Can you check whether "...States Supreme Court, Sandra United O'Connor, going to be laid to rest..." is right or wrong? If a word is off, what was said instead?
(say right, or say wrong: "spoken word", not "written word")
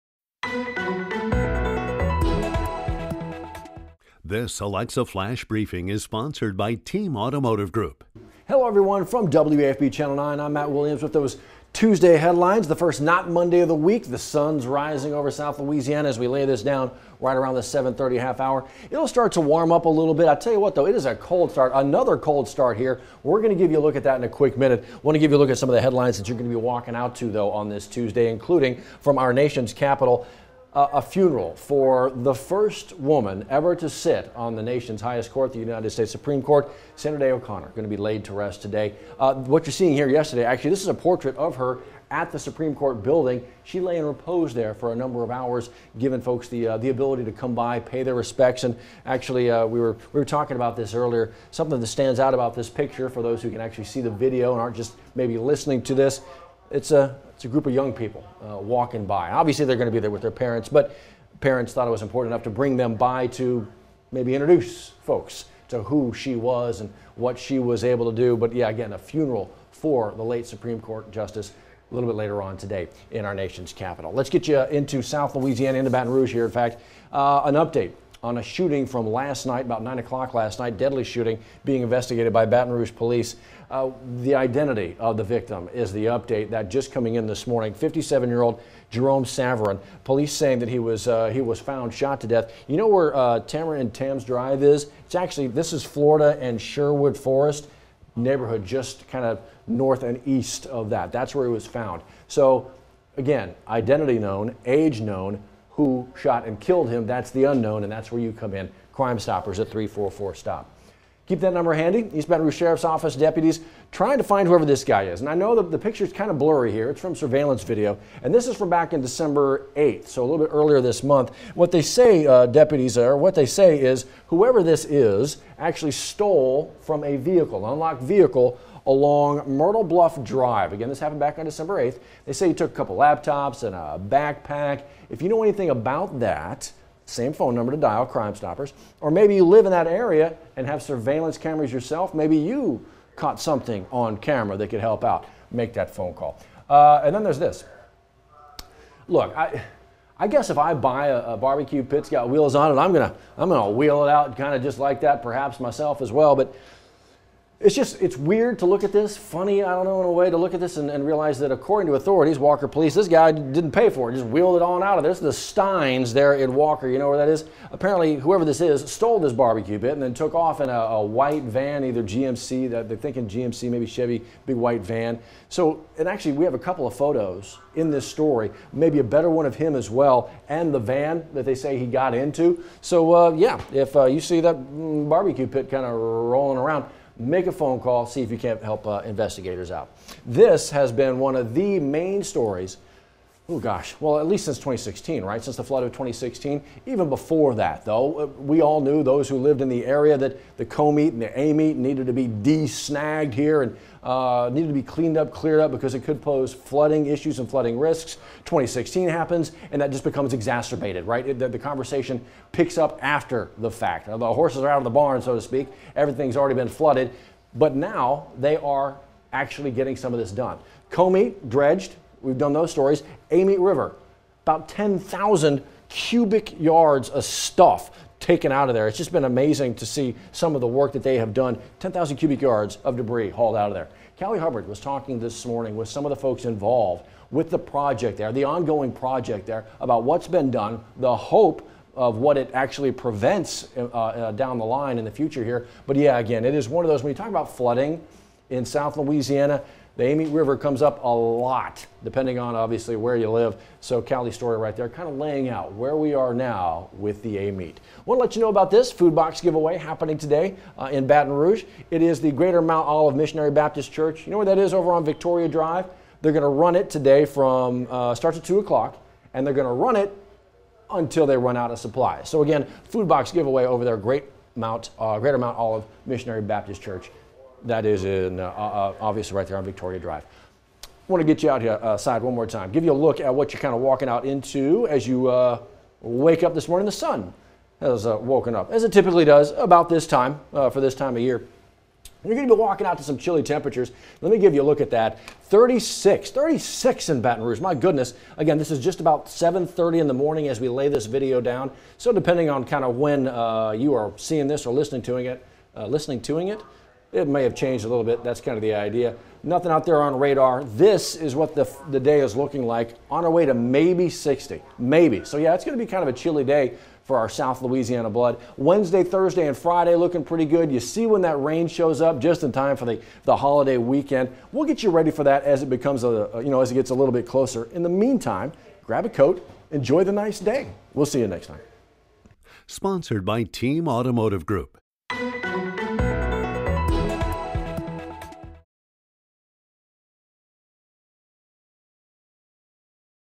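wrong: "Day", not "United".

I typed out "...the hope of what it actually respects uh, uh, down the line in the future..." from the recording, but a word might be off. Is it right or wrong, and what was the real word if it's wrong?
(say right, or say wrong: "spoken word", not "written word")
wrong: "prevents", not "respects".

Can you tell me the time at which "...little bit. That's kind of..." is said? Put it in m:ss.
5:07.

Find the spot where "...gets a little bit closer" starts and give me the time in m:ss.
5:26.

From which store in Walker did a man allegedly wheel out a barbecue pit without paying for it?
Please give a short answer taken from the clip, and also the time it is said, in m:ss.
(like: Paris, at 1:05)
Stine's, at 2:45.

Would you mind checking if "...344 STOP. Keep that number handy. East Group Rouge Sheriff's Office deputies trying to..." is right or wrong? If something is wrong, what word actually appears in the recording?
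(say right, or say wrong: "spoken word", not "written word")
wrong: "Baton", not "Group".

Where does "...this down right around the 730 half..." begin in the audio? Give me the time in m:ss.
0:16.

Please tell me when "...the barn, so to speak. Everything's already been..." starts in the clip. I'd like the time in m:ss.
3:34.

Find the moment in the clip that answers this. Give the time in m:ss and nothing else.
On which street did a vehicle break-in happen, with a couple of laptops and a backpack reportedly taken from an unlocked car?
2:09.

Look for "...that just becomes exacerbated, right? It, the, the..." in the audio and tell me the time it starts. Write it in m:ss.
3:29.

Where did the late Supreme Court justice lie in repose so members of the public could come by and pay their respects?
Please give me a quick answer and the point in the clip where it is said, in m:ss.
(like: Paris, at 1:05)
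Supreme Court building, at 0:42.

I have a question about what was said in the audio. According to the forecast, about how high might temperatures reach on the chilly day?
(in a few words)
60.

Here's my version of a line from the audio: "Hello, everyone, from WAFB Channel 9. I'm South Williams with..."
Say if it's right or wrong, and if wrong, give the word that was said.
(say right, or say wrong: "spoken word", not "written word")
wrong: "Matt", not "South".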